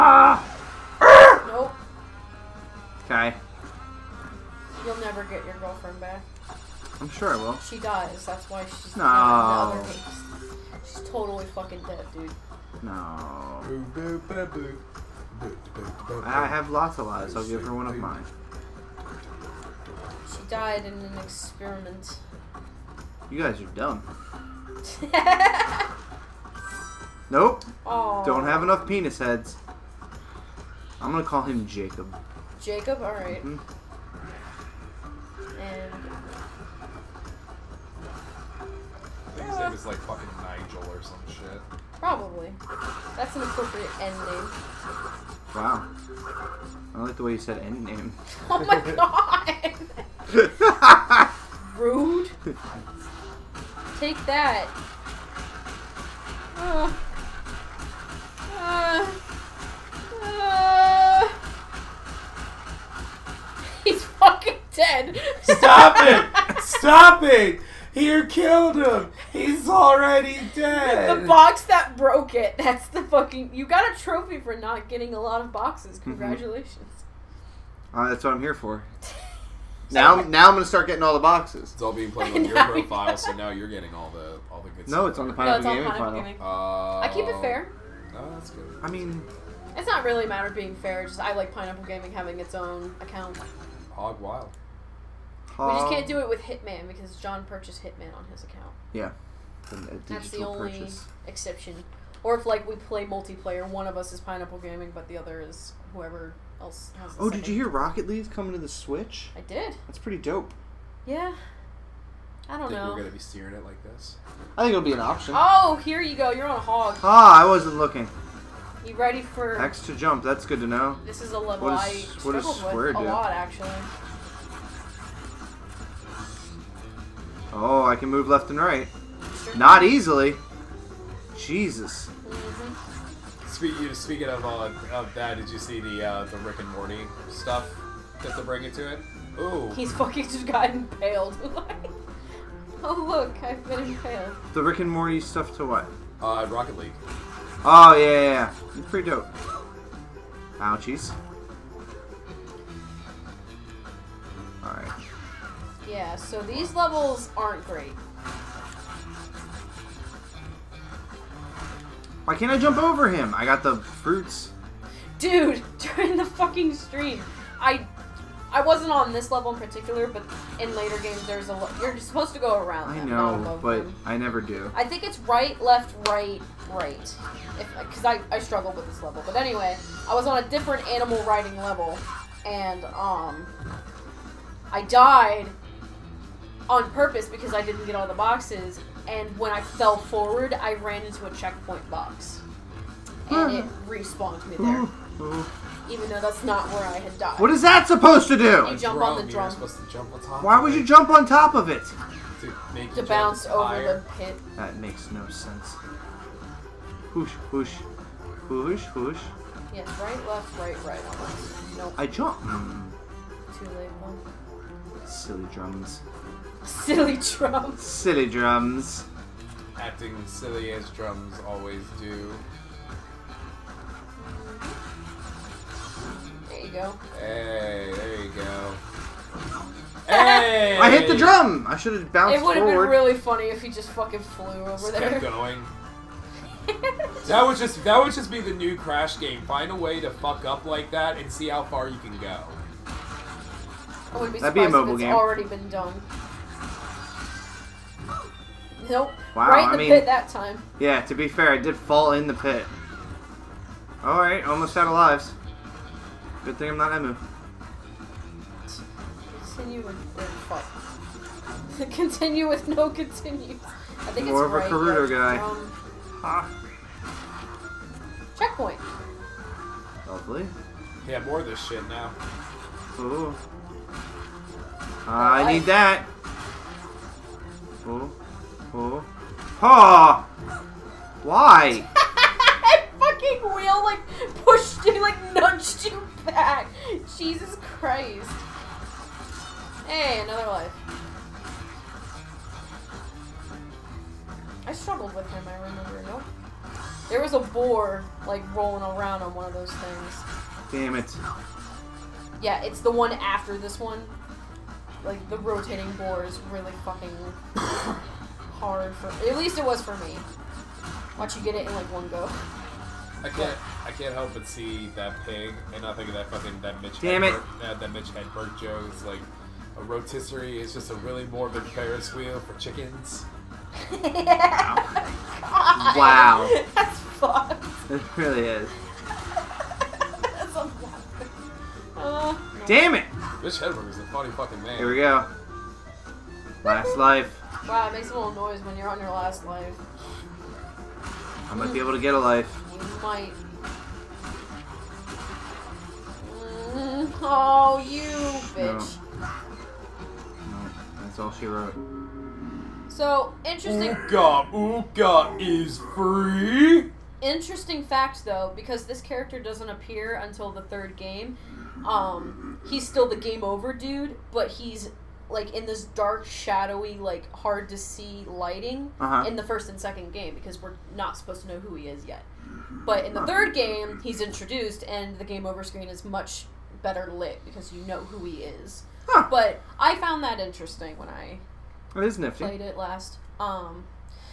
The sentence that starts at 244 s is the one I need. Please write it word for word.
I would be That'd be a mobile game.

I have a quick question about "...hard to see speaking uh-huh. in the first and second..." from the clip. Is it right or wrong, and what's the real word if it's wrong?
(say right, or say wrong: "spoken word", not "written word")
wrong: "lighting", not "speaking".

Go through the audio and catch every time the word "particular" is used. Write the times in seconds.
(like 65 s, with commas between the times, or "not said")
169 s.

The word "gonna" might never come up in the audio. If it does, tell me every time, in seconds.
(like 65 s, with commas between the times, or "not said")
31 s, 80 s, 112 s.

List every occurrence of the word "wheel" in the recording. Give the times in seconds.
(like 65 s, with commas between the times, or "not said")
283 s, 322 s.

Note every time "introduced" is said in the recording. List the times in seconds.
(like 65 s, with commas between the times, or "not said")
374 s.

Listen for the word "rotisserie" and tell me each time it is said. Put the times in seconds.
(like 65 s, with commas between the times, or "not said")
319 s.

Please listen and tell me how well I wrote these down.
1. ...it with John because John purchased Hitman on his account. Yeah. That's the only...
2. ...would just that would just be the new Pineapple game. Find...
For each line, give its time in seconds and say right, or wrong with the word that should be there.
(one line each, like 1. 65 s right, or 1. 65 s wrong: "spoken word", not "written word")
1. 96 s wrong: "Hitman", not "John"
2. 237 s wrong: "Crash", not "Pineapple".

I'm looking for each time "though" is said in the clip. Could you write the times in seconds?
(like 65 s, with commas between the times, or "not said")
196 s, 358 s.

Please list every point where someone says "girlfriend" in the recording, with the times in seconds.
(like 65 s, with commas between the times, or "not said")
5 s.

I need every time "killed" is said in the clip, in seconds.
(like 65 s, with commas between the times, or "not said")
68 s.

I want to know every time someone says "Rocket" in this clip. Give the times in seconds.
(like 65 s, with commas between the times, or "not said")
107 s, 146 s.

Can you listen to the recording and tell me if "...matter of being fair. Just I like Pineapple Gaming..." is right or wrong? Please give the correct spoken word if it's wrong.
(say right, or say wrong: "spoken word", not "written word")
right.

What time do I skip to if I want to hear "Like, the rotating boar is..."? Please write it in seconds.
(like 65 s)
305 s.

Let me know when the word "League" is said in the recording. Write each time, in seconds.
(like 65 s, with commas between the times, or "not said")
108 s, 146 s.